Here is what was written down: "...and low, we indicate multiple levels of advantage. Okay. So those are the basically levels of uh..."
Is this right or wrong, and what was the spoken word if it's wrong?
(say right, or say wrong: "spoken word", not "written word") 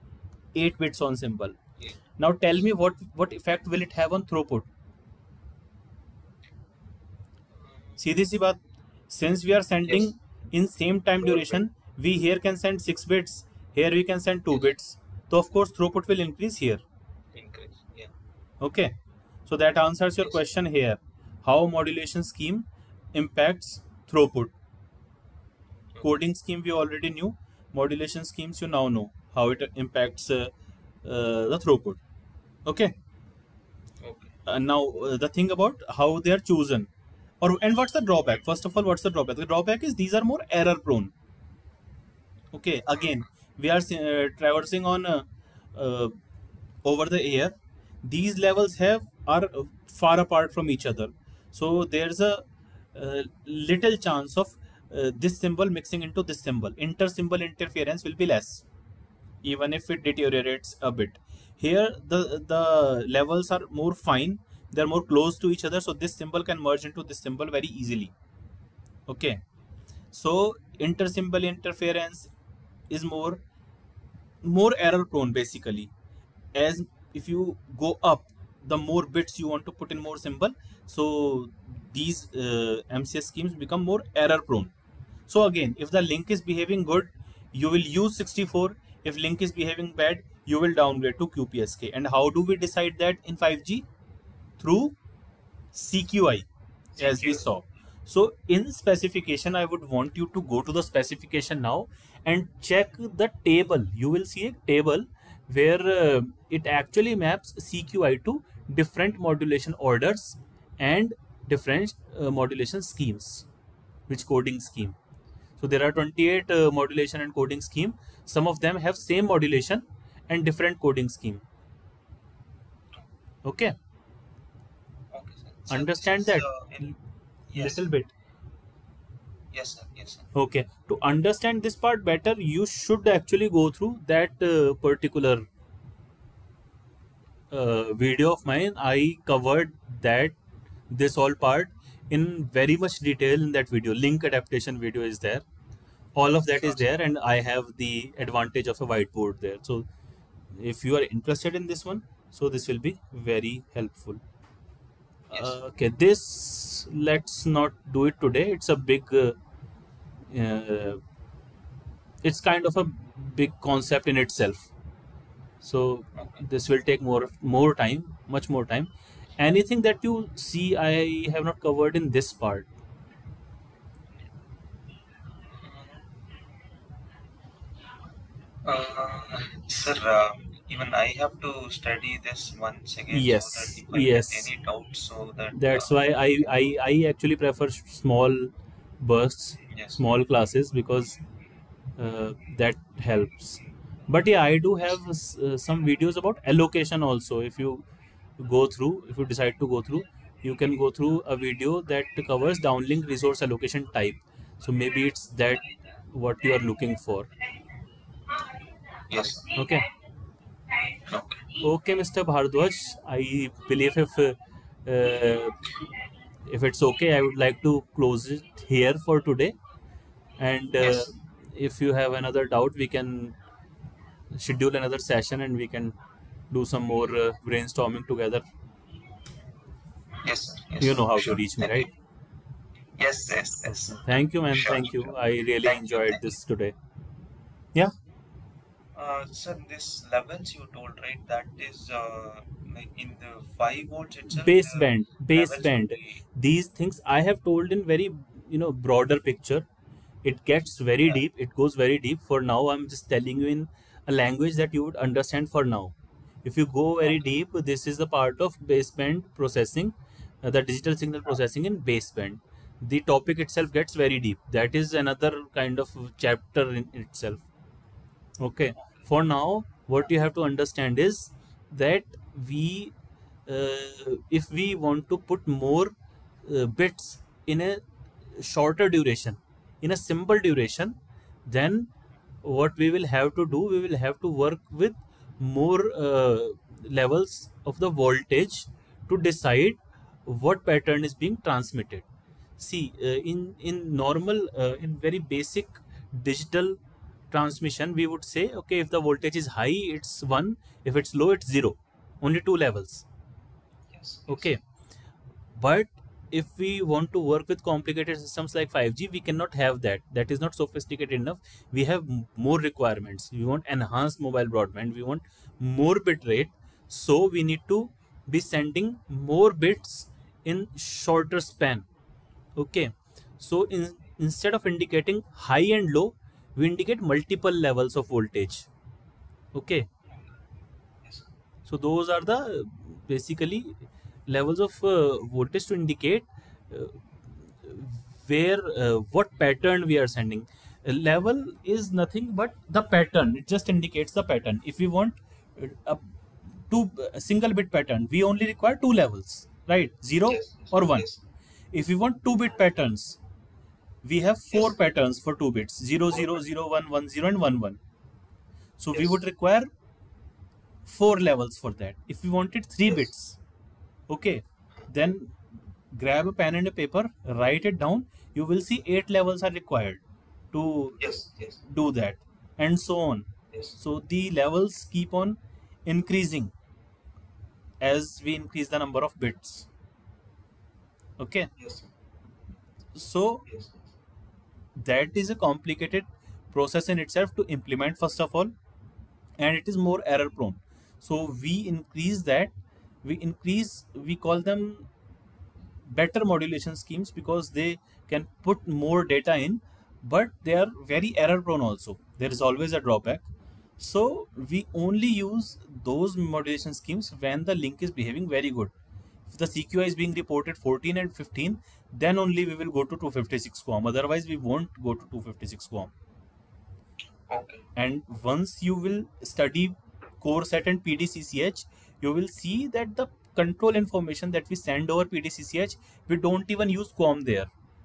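wrong: "voltage", not "advantage".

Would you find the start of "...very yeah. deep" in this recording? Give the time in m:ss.
4:10.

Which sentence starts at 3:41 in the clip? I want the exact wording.
if you have another doubt we can schedule another session and we can do some more uh, brainstorming together.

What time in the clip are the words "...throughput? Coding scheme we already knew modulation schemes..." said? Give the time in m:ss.
0:24.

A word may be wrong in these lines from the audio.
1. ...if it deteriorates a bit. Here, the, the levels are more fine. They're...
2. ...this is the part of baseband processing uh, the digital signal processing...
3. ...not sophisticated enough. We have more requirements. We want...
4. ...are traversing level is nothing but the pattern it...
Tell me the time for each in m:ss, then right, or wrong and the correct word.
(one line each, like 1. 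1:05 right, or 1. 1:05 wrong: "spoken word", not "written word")
1. 0:59 right
2. 4:17 right
3. 5:10 right
4. 5:40 wrong: "sending", not "traversing".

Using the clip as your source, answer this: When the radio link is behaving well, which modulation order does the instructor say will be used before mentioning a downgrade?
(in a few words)
64.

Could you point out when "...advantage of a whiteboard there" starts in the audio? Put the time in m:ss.
2:28.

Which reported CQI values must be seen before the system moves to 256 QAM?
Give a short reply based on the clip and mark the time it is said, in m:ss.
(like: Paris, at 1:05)
14 and 15, at 6:50.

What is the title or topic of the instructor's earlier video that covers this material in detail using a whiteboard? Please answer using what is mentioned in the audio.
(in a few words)
Link adaptation.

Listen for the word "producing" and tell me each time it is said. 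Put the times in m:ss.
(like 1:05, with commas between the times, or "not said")
not said.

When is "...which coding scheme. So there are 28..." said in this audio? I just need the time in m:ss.
1:54.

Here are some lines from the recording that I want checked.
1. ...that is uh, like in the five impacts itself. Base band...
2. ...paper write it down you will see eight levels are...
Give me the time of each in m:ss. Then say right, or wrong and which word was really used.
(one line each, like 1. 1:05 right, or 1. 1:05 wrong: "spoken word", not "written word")
1. 4:01 wrong: "volts", not "impacts"
2. 6:06 right.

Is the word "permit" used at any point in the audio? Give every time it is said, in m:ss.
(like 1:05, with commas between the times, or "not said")
not said.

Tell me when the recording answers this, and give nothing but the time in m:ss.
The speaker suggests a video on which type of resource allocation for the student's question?
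3:22.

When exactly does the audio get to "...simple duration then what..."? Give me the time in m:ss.
4:39.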